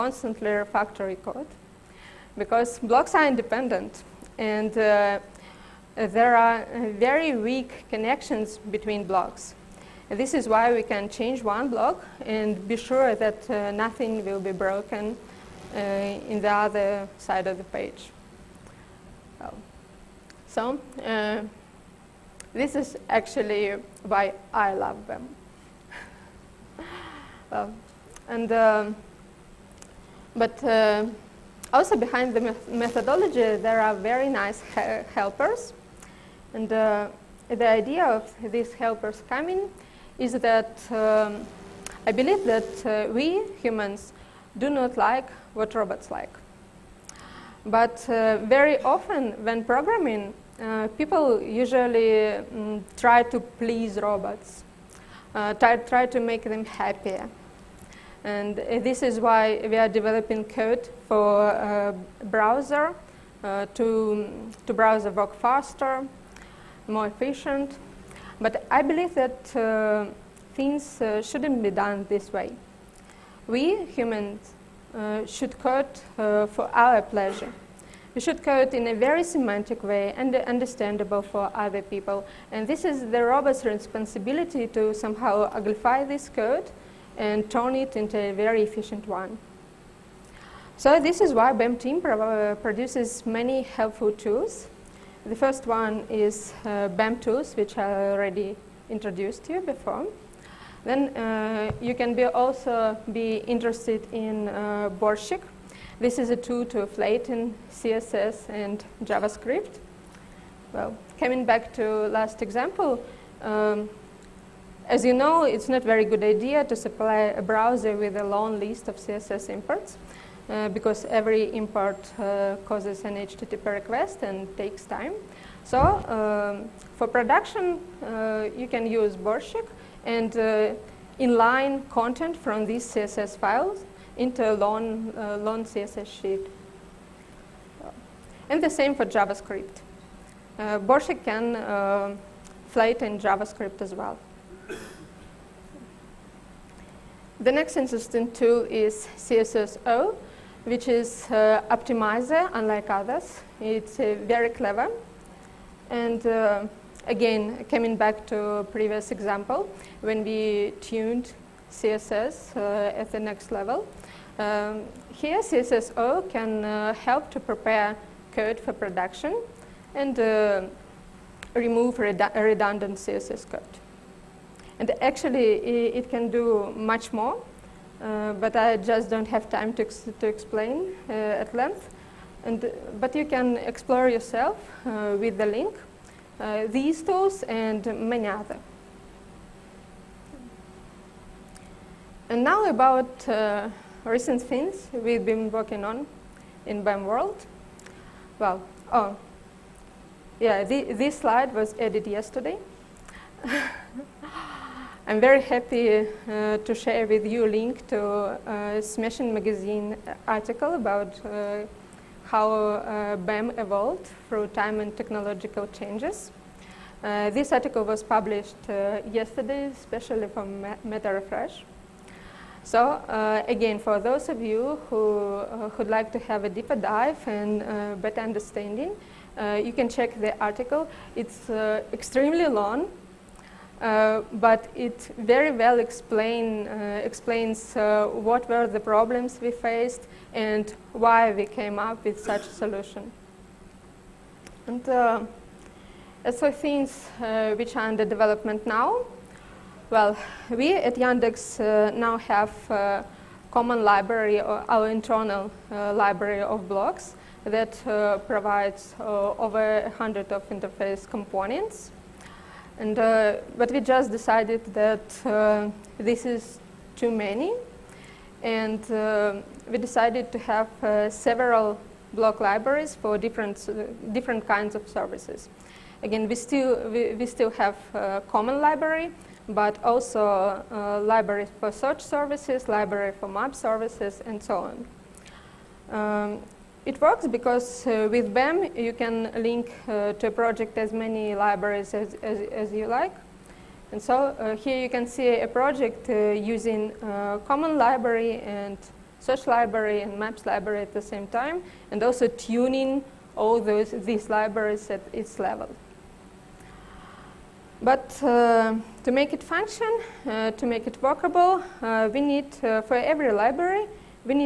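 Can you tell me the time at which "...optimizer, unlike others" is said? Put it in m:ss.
2:31.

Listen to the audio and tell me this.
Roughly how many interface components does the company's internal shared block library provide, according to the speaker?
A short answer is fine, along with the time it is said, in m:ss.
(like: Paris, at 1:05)
over 100, at 4:19.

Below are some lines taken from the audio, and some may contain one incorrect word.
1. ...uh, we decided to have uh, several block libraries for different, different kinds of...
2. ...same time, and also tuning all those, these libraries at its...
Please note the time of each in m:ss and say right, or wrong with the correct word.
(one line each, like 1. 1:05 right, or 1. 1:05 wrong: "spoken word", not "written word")
1. 4:28 right
2. 5:01 right.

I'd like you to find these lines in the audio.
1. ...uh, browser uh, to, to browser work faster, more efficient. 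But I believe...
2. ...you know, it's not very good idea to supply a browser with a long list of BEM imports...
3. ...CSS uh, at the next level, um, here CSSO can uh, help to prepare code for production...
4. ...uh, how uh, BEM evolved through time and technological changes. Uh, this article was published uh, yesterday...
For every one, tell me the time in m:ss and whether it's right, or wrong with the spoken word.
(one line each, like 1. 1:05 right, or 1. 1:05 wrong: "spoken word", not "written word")
1. 1:01 right
2. 1:55 wrong: "CSS", not "BEM"
3. 2:41 right
4. 3:31 right.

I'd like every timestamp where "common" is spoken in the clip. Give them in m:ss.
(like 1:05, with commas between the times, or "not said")
4:13, 4:38, 4:57.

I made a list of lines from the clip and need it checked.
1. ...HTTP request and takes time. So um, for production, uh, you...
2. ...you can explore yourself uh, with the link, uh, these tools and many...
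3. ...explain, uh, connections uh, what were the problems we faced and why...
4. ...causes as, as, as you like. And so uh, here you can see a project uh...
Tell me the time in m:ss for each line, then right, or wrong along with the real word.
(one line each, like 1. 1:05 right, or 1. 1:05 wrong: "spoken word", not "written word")
1. 2:03 right
2. 3:03 right
3. 3:55 wrong: "explains", not "connections"
4. 4:51 wrong: "libraries", not "causes".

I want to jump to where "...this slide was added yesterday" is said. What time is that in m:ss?
3:20.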